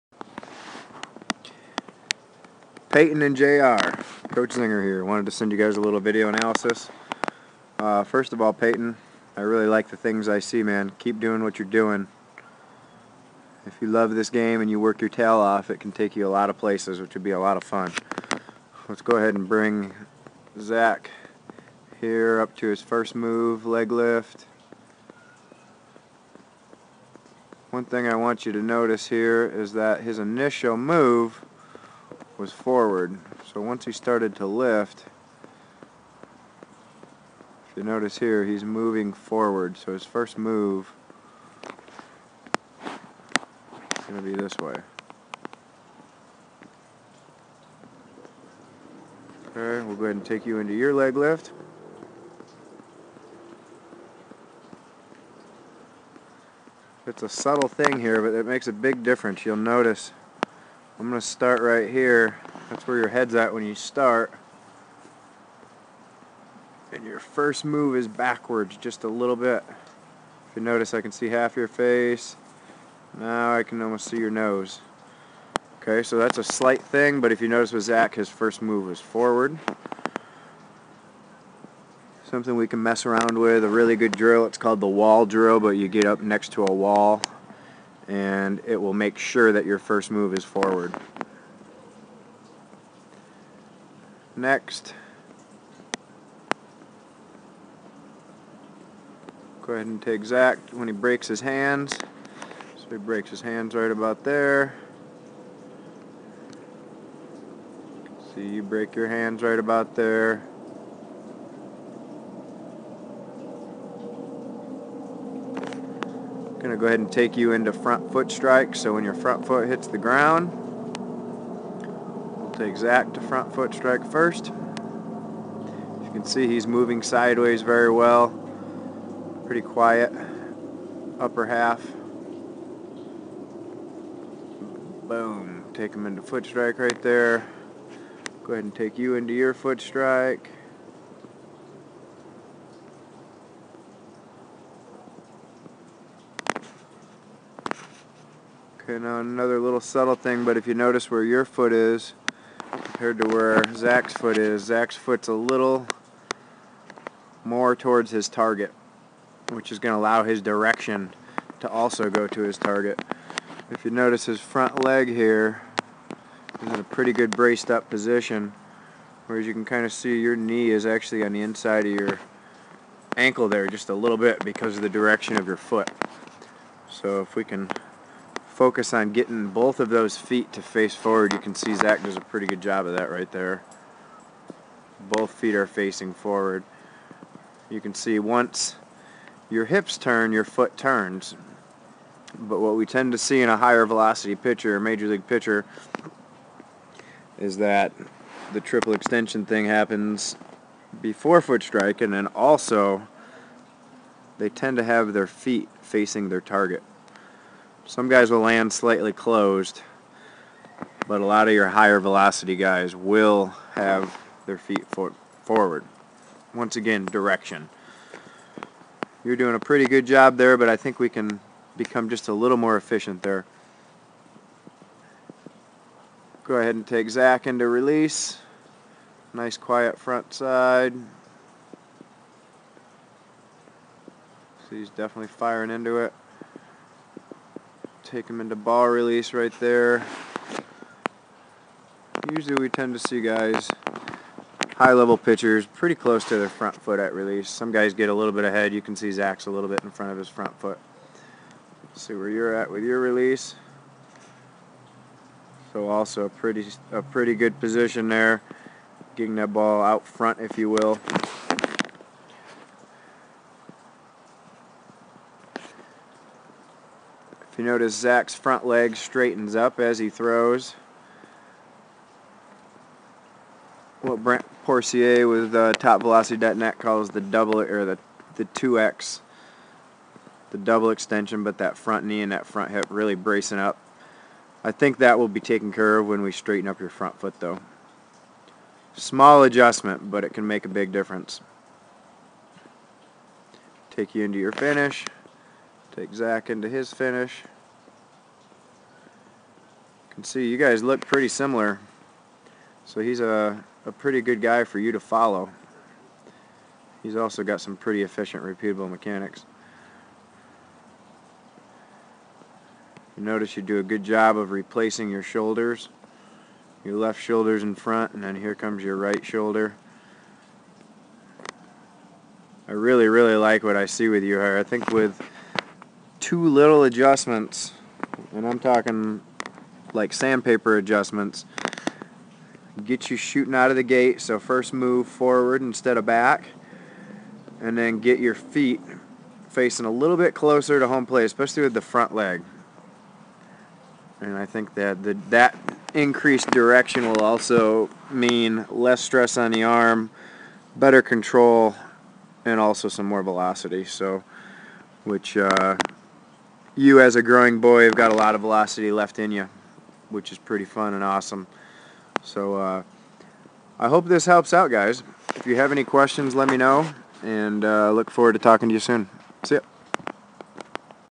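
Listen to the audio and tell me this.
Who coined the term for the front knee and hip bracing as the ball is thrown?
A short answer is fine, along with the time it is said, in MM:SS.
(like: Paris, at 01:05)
Brent Pourciau, at 04:34.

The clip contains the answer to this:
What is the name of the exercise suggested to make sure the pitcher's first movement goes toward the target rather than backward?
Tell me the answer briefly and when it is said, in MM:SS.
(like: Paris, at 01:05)
wall drill, at 01:24.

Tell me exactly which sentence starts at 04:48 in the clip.
Small adjustment, but it can make a big difference.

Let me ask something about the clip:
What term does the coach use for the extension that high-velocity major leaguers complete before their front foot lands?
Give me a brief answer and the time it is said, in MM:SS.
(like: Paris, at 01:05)
triple extension, at 03:18.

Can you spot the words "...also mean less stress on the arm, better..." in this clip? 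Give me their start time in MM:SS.
05:47.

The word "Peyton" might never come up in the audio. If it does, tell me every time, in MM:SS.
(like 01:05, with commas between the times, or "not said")
00:02, 00:08.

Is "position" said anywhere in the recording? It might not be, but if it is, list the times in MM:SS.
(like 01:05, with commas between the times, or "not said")
02:47, 04:17.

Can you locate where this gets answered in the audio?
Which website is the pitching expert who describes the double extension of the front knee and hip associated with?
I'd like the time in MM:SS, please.
04:35.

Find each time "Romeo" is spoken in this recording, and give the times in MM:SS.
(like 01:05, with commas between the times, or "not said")
not said.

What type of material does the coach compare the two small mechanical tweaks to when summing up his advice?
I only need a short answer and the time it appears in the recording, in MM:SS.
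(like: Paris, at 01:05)
sandpaper, at 05:30.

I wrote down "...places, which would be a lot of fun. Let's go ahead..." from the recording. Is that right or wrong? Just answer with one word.
right.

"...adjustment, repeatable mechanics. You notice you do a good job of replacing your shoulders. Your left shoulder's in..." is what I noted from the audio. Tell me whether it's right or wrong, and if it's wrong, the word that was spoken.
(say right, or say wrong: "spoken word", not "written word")
wrong: "efficient", not "adjustment".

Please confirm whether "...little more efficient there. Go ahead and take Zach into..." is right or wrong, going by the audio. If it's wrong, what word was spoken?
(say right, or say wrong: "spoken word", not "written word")
right.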